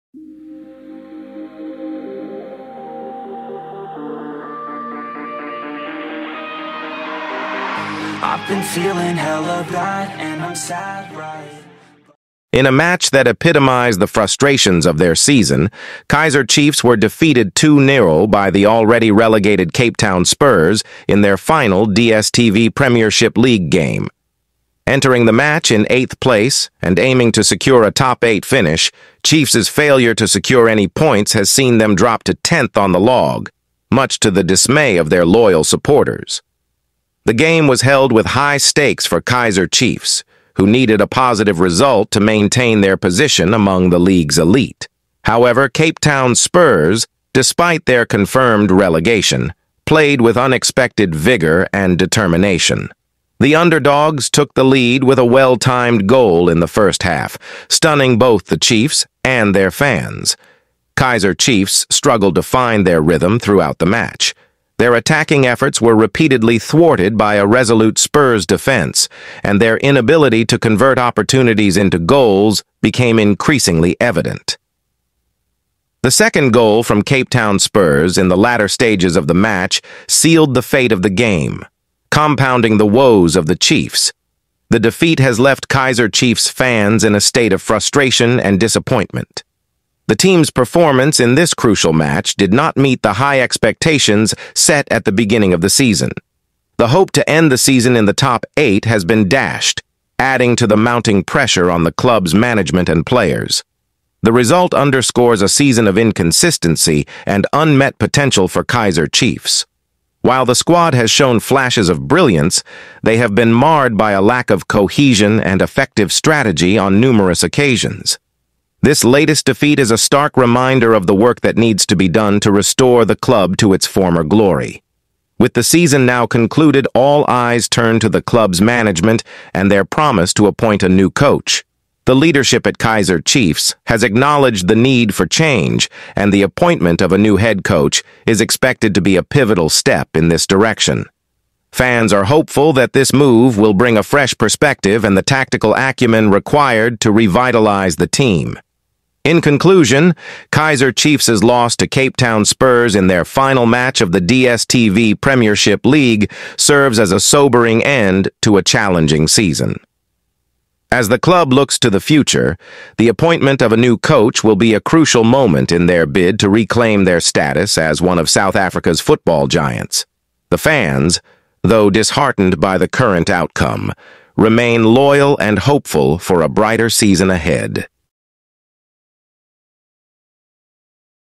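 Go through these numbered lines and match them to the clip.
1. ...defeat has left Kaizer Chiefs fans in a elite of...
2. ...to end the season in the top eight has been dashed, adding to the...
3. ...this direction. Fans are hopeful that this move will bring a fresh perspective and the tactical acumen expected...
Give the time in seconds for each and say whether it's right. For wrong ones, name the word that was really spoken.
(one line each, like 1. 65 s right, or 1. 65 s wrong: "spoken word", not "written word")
1. 84 s wrong: "state", not "elite"
2. 97 s right
3. 140 s wrong: "required", not "expected".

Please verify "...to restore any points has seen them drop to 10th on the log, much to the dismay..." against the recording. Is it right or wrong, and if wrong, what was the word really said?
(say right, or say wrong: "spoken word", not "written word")
wrong: "secure", not "restore".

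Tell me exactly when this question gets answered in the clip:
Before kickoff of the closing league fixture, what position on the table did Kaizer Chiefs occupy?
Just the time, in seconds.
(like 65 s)
25 s.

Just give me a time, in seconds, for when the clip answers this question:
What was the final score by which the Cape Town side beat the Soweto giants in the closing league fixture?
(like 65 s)
17 s.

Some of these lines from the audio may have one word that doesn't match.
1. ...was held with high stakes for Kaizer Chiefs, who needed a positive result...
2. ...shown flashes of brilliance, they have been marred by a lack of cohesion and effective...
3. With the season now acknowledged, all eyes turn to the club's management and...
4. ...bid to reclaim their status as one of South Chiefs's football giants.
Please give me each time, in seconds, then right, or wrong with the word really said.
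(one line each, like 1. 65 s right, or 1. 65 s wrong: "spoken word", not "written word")
1. 37 s right
2. 111 s right
3. 125 s wrong: "concluded", not "acknowledged"
4. 166 s wrong: "Africa", not "Chiefs".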